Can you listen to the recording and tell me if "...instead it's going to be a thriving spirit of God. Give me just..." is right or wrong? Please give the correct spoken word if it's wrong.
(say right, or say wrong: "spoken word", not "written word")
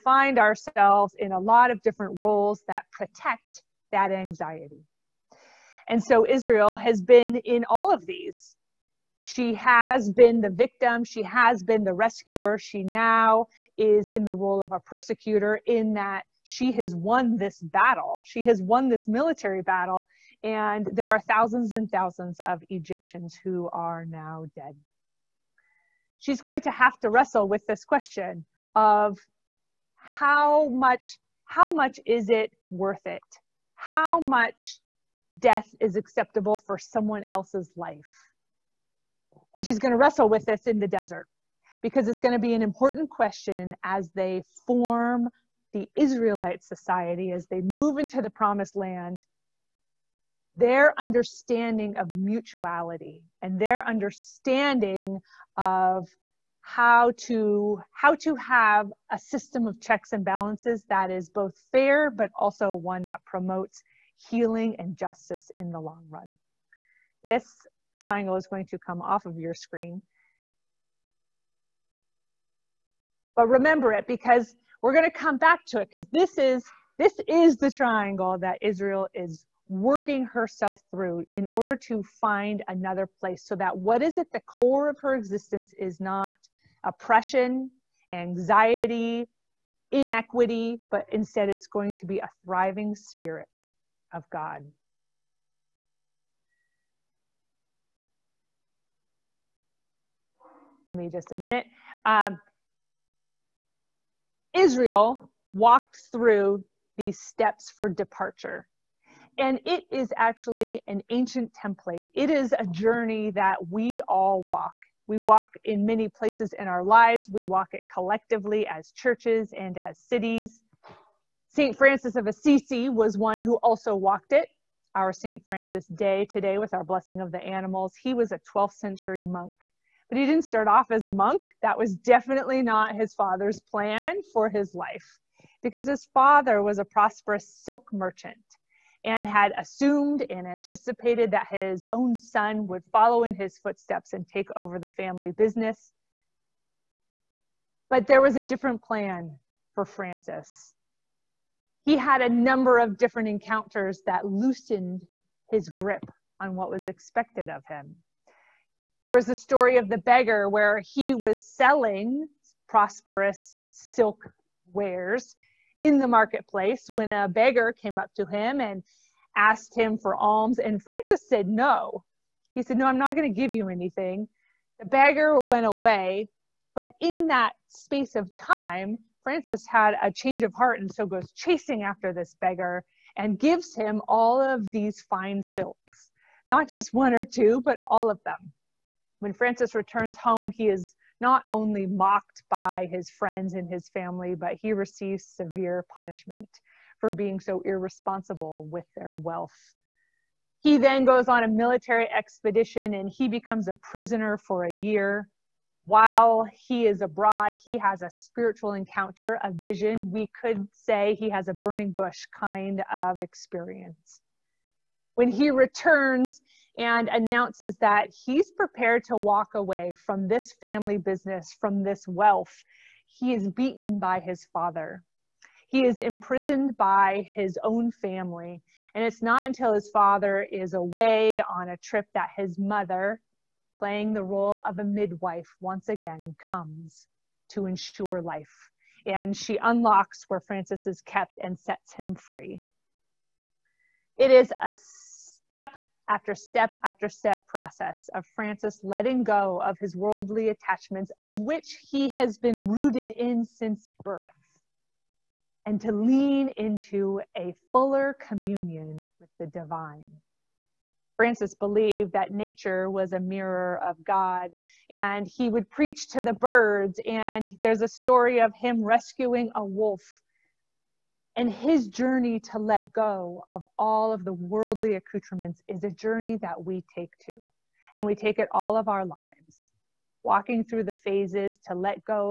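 right.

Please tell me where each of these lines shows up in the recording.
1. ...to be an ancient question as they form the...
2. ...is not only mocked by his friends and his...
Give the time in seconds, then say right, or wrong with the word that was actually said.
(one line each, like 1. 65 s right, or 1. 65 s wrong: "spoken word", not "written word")
1. 42 s wrong: "important", not "ancient"
2. 190 s right.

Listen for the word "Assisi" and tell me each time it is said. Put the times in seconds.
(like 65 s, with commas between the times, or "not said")
122 s.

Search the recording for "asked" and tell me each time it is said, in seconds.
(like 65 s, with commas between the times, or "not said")
169 s.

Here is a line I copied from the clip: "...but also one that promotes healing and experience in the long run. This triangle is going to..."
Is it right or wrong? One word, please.
wrong.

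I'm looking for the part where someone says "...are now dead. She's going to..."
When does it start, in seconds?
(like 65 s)
23 s.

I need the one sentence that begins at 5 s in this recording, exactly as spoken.
And so Israel has been in all of these.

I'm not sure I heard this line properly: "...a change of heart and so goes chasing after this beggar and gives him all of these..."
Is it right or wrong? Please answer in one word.
right.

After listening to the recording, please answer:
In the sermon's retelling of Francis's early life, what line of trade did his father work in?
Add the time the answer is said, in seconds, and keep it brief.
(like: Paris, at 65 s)
silk merchant, at 137 s.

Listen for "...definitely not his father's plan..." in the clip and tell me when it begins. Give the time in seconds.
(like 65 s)
131 s.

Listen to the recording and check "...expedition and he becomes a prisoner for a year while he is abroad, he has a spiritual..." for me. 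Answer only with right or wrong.
right.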